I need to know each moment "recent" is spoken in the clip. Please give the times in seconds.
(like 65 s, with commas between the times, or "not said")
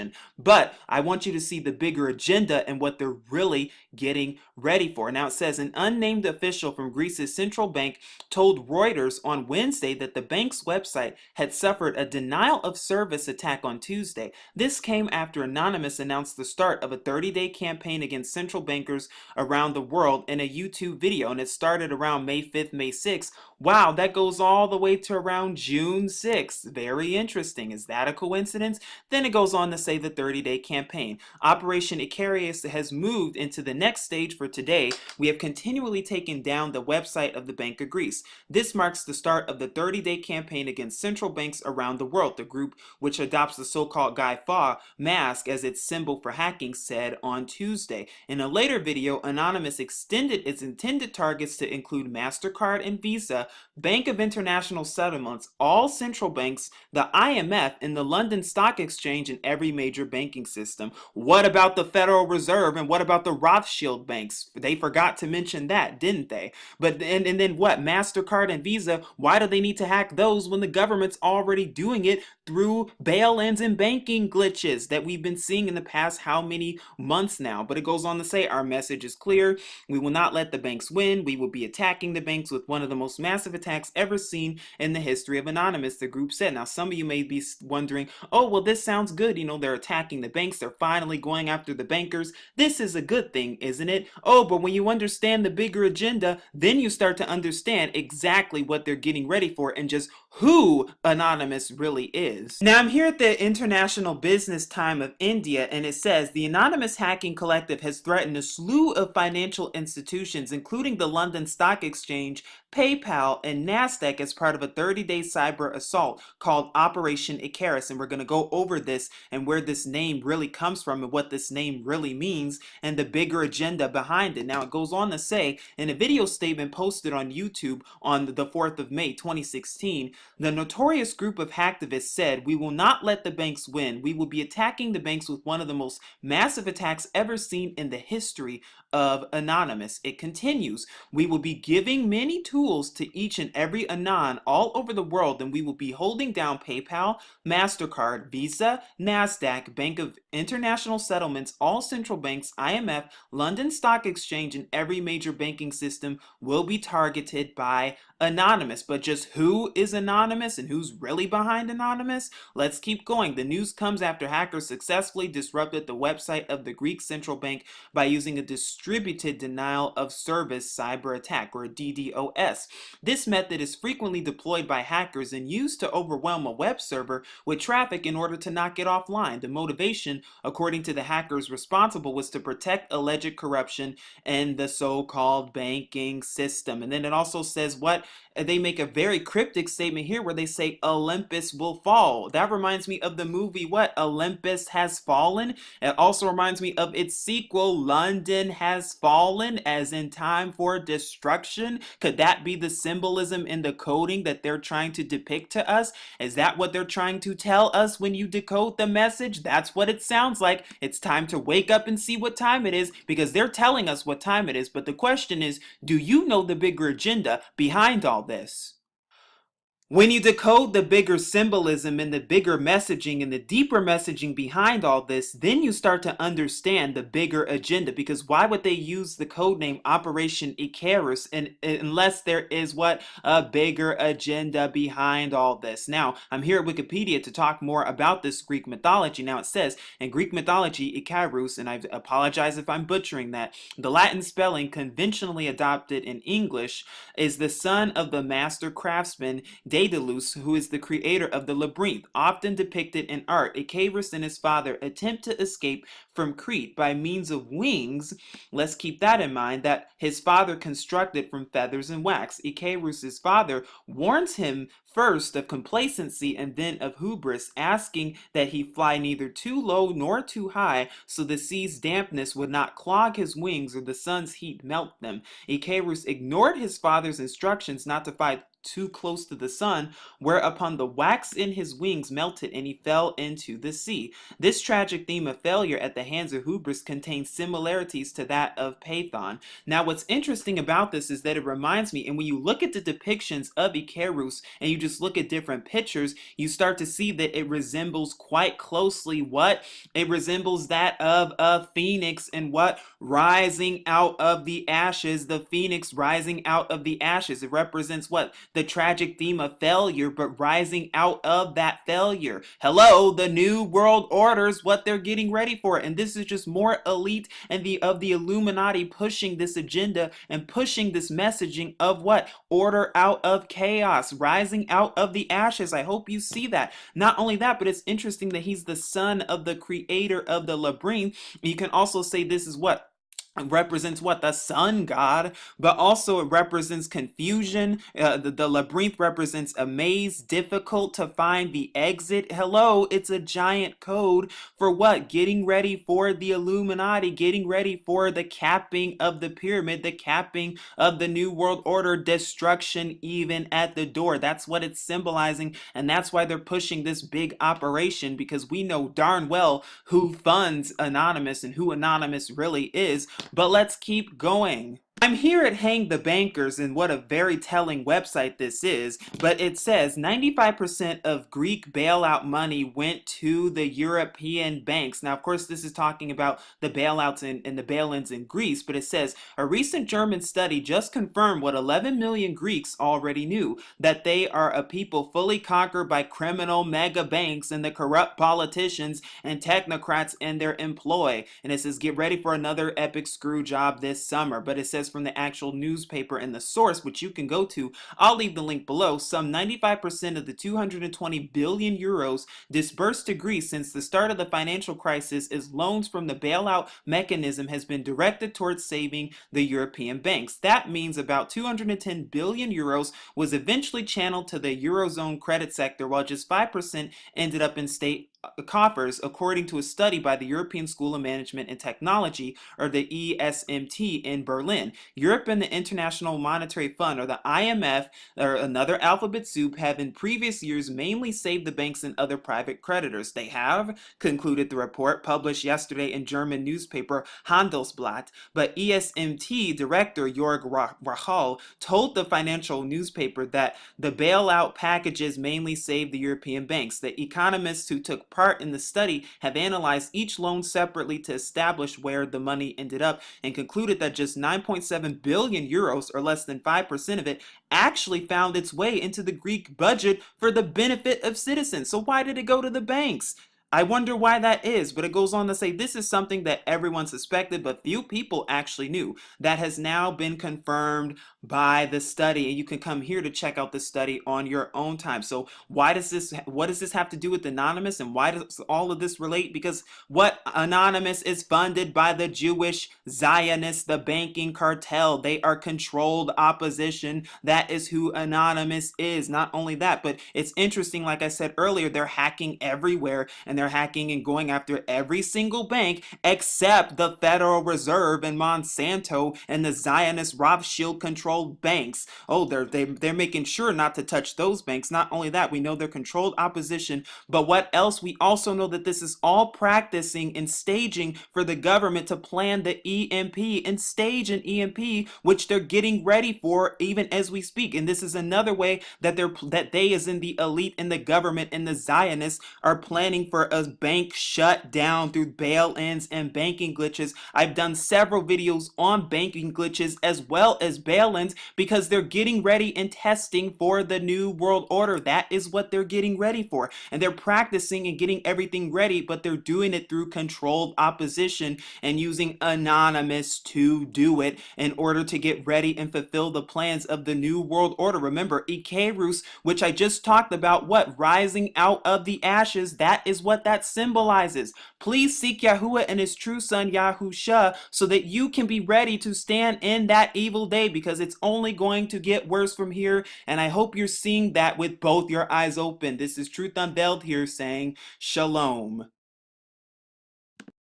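379 s.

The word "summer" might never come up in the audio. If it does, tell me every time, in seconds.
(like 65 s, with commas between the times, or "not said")
394 s.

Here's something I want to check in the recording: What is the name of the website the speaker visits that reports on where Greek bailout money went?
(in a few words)
Hang the Bankers.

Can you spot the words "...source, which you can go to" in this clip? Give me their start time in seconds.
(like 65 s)
396 s.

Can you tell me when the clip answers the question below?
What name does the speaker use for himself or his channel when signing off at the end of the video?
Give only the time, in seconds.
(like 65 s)
566 s.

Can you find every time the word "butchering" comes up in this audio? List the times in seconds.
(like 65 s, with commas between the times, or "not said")
242 s.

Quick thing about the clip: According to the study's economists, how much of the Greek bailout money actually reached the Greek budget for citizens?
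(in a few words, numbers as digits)
9.7 billion euros.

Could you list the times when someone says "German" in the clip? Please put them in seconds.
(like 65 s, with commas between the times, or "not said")
379 s, 436 s.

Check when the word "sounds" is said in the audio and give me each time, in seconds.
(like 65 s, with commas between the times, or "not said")
88 s, 210 s.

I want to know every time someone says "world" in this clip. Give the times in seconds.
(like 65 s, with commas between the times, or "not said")
19 s, 42 s, 145 s, 313 s, 351 s, 534 s, 547 s.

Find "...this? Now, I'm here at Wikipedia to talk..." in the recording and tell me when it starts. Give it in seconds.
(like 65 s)
235 s.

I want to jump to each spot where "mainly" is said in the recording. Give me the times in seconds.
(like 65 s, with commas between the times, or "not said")
430 s, 445 s.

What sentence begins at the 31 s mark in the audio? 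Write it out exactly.
Operation Icarus has moved into the next stage for today.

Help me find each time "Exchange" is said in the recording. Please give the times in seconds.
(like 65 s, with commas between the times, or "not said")
58 s, 111 s, 154 s.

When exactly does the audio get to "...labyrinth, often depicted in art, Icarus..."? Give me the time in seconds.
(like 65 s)
251 s.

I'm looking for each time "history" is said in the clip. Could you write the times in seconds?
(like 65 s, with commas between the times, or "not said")
84 s, 137 s.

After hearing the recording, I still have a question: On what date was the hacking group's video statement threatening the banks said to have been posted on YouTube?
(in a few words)
May 4, 2016.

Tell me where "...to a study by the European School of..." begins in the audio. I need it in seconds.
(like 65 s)
419 s.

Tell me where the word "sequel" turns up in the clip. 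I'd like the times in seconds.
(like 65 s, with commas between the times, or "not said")
197 s.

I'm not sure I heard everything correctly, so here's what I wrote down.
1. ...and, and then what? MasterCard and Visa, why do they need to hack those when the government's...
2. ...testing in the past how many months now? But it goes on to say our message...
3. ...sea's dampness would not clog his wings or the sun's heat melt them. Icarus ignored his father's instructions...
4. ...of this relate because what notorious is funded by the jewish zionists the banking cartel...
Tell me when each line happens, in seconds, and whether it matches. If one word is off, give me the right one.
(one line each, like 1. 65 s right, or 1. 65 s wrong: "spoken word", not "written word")
1. 67 s right
2. 75 s wrong: "seeing", not "testing"
3. 271 s right
4. 478 s wrong: "anonymous", not "notorious".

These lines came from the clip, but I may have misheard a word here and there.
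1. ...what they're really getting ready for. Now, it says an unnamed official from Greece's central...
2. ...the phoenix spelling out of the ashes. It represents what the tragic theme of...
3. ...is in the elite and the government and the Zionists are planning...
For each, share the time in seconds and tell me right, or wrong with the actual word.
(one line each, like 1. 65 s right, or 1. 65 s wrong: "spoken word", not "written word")
1. 2 s right
2. 305 s wrong: "rising", not "spelling"
3. 519 s right.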